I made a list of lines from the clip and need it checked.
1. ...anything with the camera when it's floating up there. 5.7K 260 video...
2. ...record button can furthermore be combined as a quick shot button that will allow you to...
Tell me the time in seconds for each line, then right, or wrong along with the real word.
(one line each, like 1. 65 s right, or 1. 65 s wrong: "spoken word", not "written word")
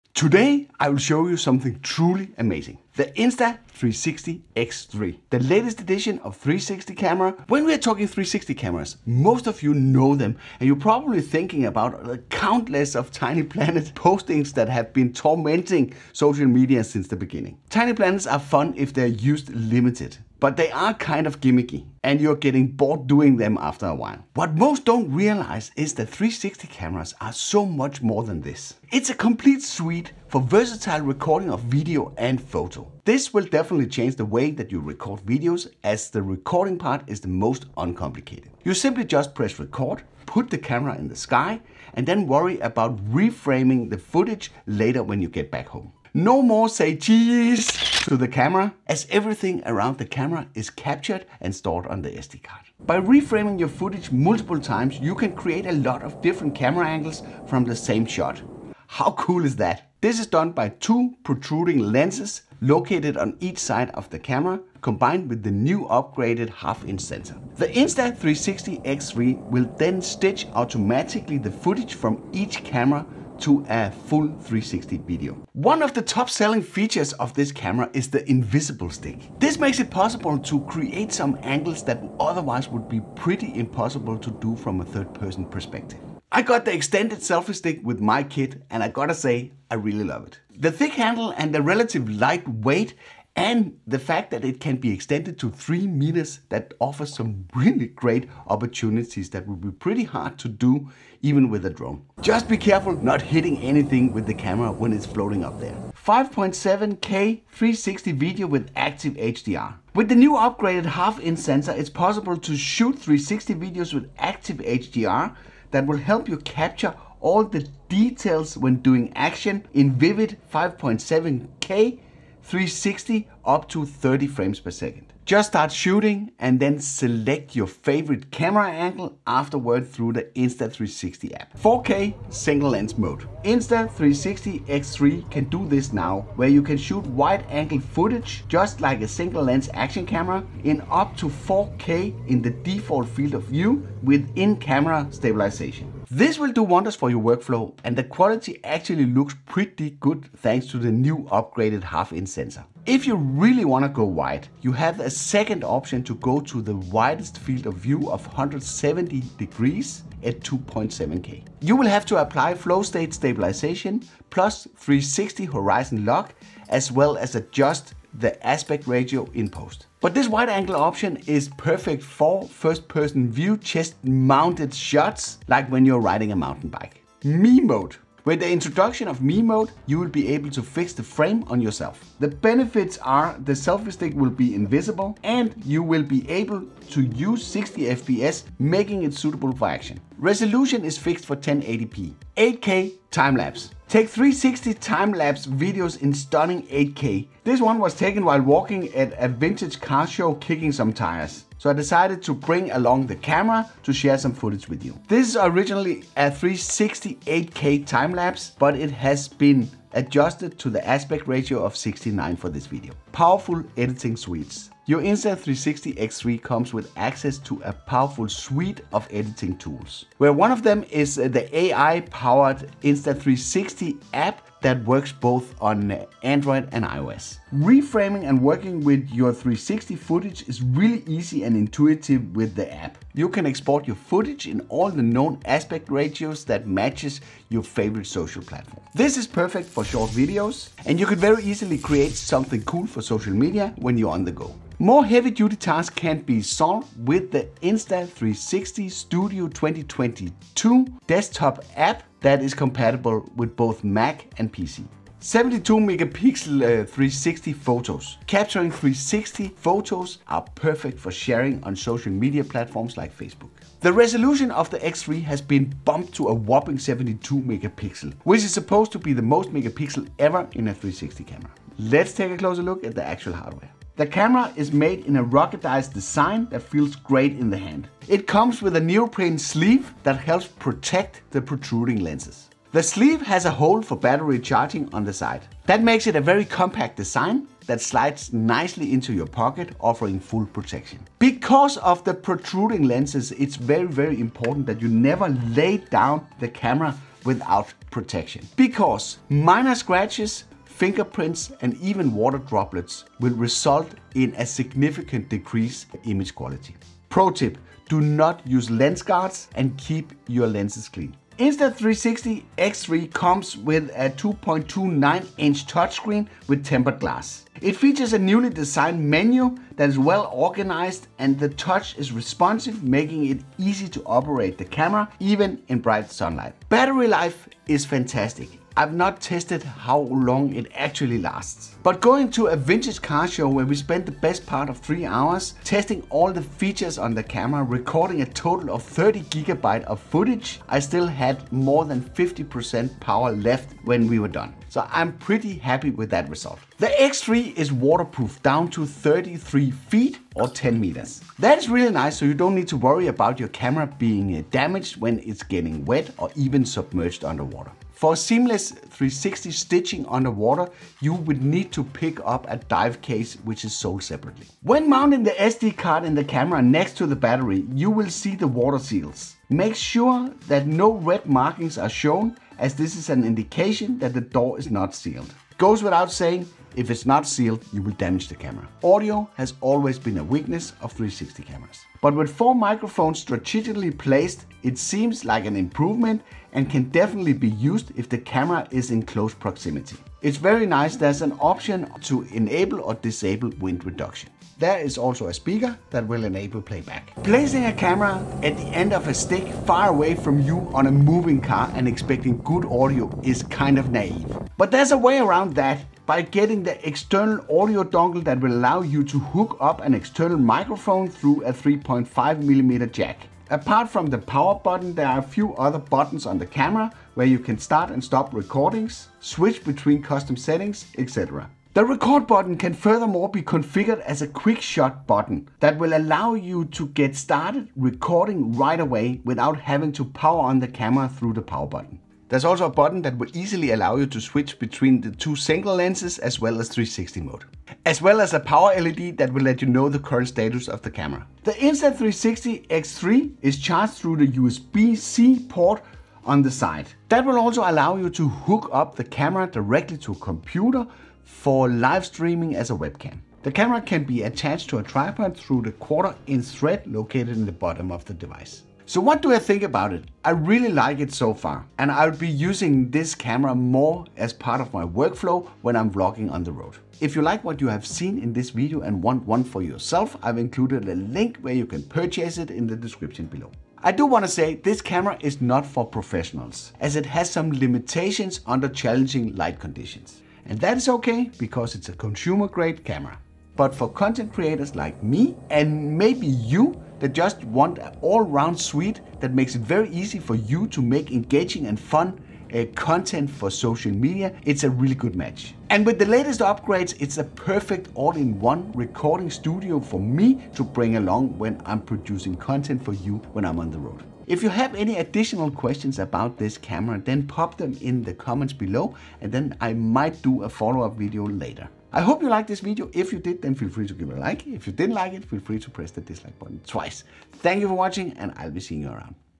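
1. 103 s wrong: "360", not "260"
2. 421 s wrong: "configured", not "combined".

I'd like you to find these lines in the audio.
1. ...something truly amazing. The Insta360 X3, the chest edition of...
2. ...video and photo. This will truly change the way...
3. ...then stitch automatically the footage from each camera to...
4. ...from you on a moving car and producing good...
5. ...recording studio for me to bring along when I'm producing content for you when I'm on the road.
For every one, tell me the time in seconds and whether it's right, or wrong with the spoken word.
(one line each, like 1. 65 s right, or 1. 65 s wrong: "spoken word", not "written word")
1. 1 s wrong: "latest", not "chest"
2. 31 s wrong: "definitely", not "truly"
3. 69 s right
4. 400 s wrong: "expecting", not "producing"
5. 498 s right.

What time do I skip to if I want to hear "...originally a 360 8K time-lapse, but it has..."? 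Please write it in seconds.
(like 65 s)
205 s.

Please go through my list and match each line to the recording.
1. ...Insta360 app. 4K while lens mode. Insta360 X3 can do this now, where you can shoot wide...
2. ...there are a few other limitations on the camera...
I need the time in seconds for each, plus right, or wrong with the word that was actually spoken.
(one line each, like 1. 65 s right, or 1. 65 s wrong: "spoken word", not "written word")
1. 130 s wrong: "single", not "while"
2. 414 s wrong: "buttons", not "limitations".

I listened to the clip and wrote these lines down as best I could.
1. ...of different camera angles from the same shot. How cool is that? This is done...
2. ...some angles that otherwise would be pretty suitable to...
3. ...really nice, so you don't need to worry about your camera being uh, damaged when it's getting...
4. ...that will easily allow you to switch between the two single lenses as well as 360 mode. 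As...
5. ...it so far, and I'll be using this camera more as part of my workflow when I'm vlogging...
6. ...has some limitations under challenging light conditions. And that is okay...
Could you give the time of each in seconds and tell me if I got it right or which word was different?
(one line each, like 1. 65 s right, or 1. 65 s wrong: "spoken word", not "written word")
1. 56 s right
2. 81 s wrong: "impossible", not "suitable"
3. 351 s right
4. 433 s right
5. 460 s right
6. 477 s right.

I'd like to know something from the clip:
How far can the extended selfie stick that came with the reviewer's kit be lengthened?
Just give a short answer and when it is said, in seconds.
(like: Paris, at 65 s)
3 meters, at 95 s.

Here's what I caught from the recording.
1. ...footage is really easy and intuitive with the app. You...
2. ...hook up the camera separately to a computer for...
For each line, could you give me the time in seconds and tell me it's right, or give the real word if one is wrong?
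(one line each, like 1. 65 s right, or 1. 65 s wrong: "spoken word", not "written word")
1. 229 s right
2. 448 s wrong: "directly", not "separately".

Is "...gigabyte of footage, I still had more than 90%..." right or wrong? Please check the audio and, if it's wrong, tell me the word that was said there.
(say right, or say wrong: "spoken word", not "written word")
wrong: "50", not "90".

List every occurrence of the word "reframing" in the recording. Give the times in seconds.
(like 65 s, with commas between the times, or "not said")
43 s, 52 s, 227 s.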